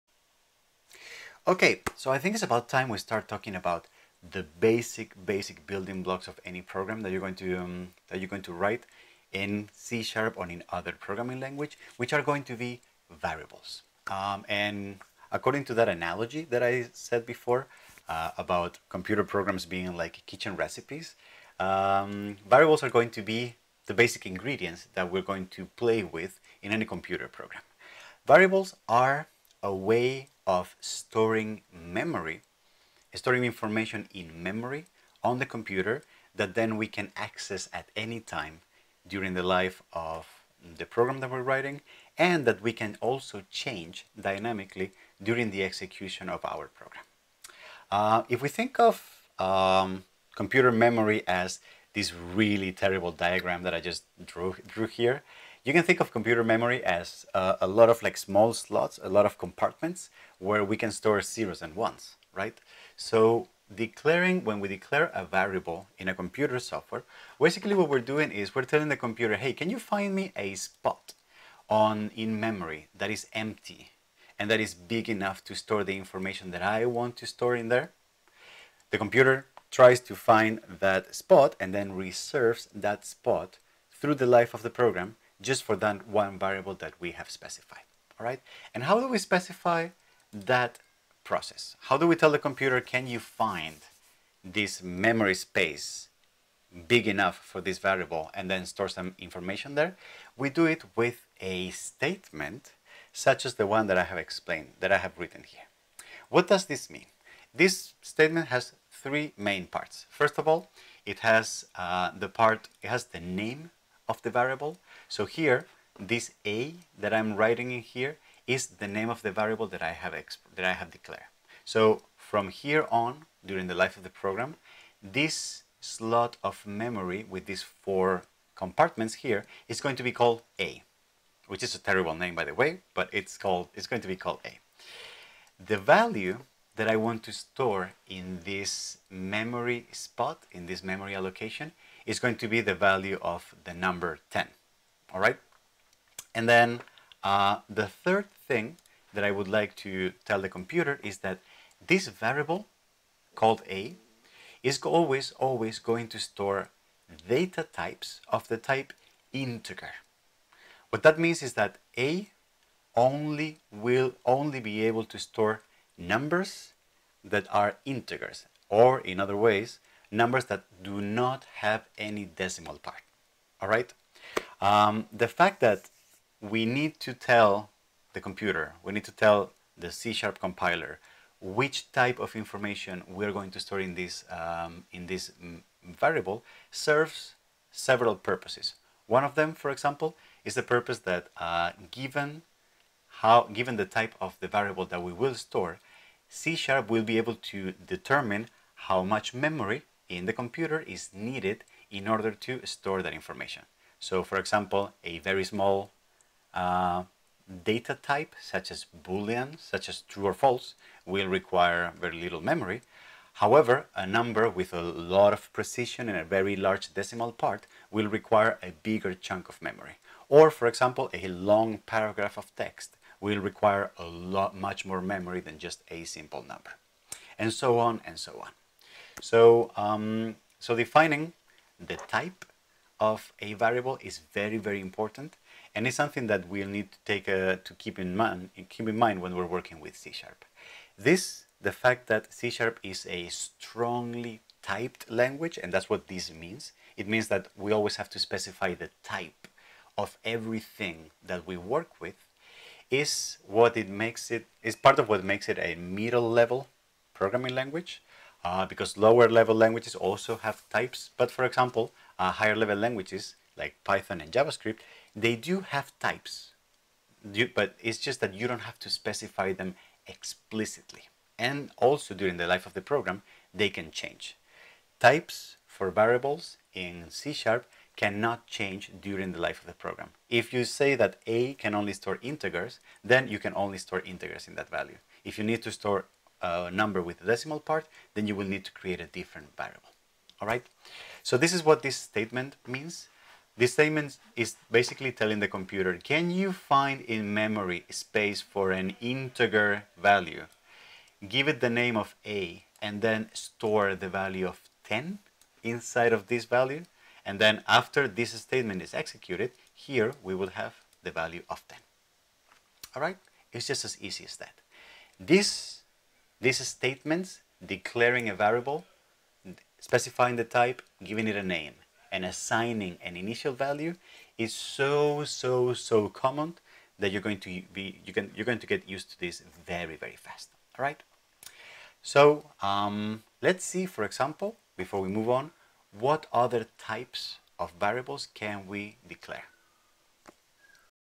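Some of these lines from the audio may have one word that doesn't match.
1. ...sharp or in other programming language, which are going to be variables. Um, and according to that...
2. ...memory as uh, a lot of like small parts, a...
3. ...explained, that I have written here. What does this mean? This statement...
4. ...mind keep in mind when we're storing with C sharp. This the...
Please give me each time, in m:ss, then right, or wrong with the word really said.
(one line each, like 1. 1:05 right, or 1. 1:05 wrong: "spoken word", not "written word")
1. 0:10 right
2. 0:56 wrong: "slots", not "parts"
3. 1:44 right
4. 3:58 wrong: "working", not "storing".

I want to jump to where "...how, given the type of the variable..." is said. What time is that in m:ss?
3:13.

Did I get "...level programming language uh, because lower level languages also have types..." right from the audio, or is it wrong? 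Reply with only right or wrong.
right.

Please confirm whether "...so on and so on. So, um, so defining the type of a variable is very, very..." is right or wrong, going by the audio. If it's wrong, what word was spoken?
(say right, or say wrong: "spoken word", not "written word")
right.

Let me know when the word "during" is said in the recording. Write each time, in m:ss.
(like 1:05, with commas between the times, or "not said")
0:39, 0:45, 2:03, 4:32, 4:38.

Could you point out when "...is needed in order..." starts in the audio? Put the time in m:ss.
3:20.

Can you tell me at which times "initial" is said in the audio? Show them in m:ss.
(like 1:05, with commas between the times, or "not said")
5:23.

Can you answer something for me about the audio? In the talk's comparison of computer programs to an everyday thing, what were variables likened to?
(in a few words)
basic ingredients.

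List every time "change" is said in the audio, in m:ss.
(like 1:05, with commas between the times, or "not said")
0:43, 4:33, 4:38.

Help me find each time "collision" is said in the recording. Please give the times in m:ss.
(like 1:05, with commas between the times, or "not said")
not said.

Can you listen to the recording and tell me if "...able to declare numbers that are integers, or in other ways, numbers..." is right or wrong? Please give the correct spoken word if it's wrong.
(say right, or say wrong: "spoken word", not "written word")
wrong: "store", not "declare".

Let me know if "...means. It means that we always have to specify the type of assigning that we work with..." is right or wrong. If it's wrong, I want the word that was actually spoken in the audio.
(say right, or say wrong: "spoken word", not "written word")
wrong: "everything", not "assigning".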